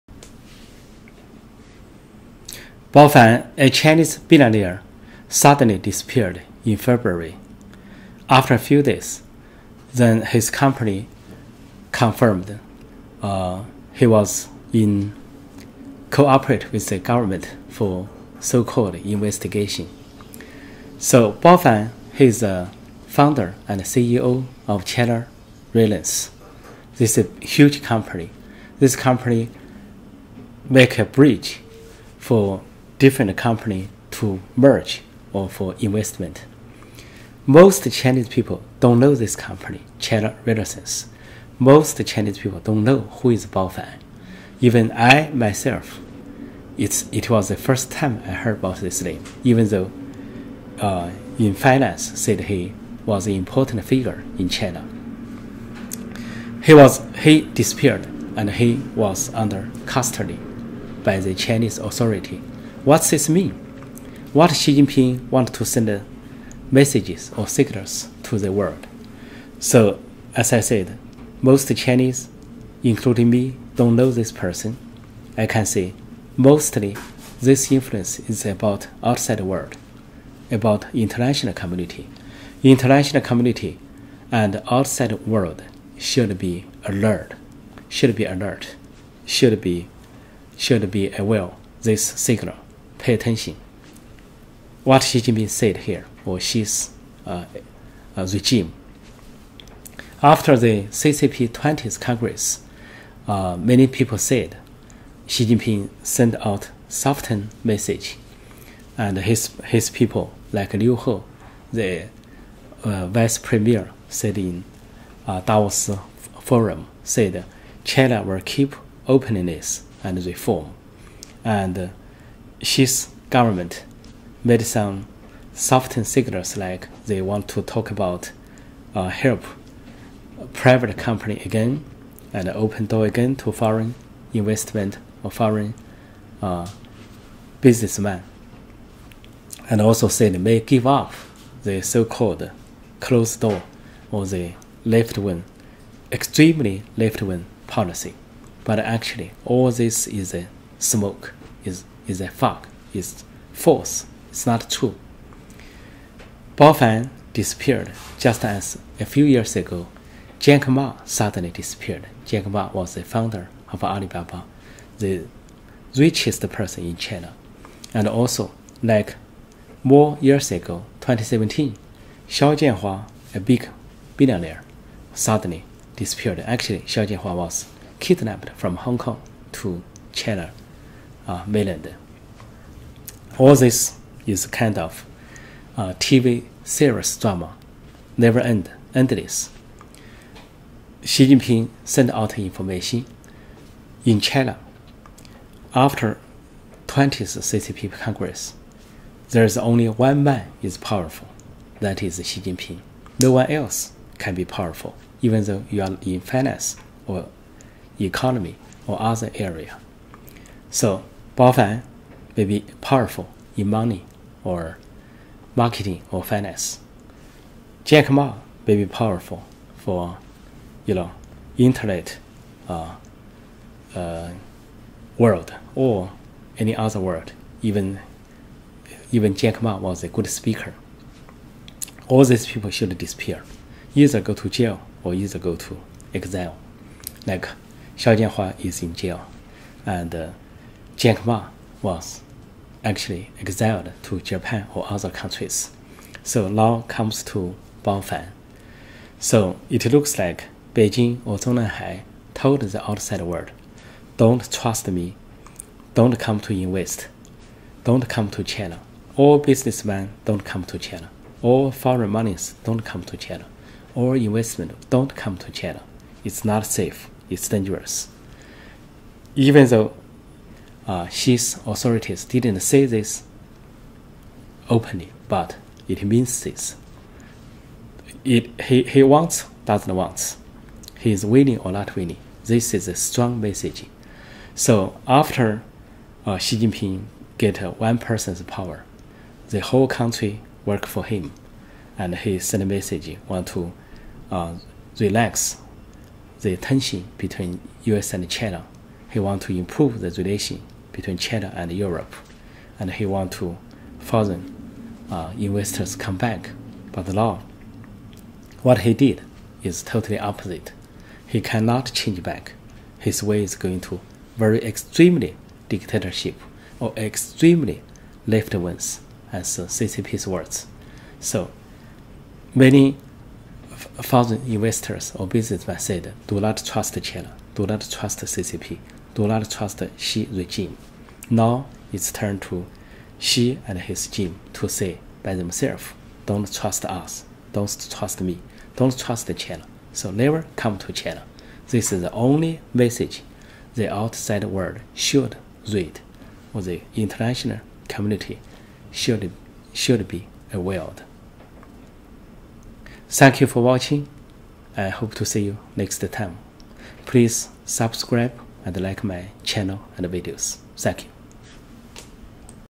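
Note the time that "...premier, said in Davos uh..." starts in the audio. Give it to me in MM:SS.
01:53.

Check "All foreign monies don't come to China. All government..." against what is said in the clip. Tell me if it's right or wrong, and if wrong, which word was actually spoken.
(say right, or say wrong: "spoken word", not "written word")
wrong: "investment", not "government".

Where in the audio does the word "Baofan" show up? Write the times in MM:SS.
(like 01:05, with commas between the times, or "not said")
00:21, 04:07.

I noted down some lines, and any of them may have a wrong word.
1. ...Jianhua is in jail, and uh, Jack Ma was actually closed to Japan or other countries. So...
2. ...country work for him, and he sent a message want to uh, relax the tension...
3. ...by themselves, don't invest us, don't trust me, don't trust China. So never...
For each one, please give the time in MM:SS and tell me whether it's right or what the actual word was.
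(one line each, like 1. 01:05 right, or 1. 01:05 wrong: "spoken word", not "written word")
1. 03:58 wrong: "exiled", not "closed"
2. 04:49 right
3. 05:35 wrong: "trust", not "invest".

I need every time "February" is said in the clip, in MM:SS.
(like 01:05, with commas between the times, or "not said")
00:06.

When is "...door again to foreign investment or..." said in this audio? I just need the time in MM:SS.
02:12.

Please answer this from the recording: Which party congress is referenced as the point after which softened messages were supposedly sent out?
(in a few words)
20th Congress.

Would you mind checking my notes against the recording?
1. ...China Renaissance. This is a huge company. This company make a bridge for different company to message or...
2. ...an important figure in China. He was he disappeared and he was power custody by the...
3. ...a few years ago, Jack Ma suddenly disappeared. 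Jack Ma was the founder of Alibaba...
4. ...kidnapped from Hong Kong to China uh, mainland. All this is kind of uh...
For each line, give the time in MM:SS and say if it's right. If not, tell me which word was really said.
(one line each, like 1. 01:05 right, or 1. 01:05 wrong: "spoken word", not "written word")
1. 00:24 wrong: "merge", not "message"
2. 00:53 wrong: "under", not "power"
3. 02:38 right
4. 02:57 right.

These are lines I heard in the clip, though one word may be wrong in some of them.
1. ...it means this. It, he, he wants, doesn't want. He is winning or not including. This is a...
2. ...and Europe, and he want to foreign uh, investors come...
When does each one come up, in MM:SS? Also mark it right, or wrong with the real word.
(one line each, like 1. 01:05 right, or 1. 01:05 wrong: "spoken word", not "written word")
1. 04:35 wrong: "winning", not "including"
2. 05:01 right.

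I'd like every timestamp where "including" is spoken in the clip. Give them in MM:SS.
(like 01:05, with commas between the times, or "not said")
01:12.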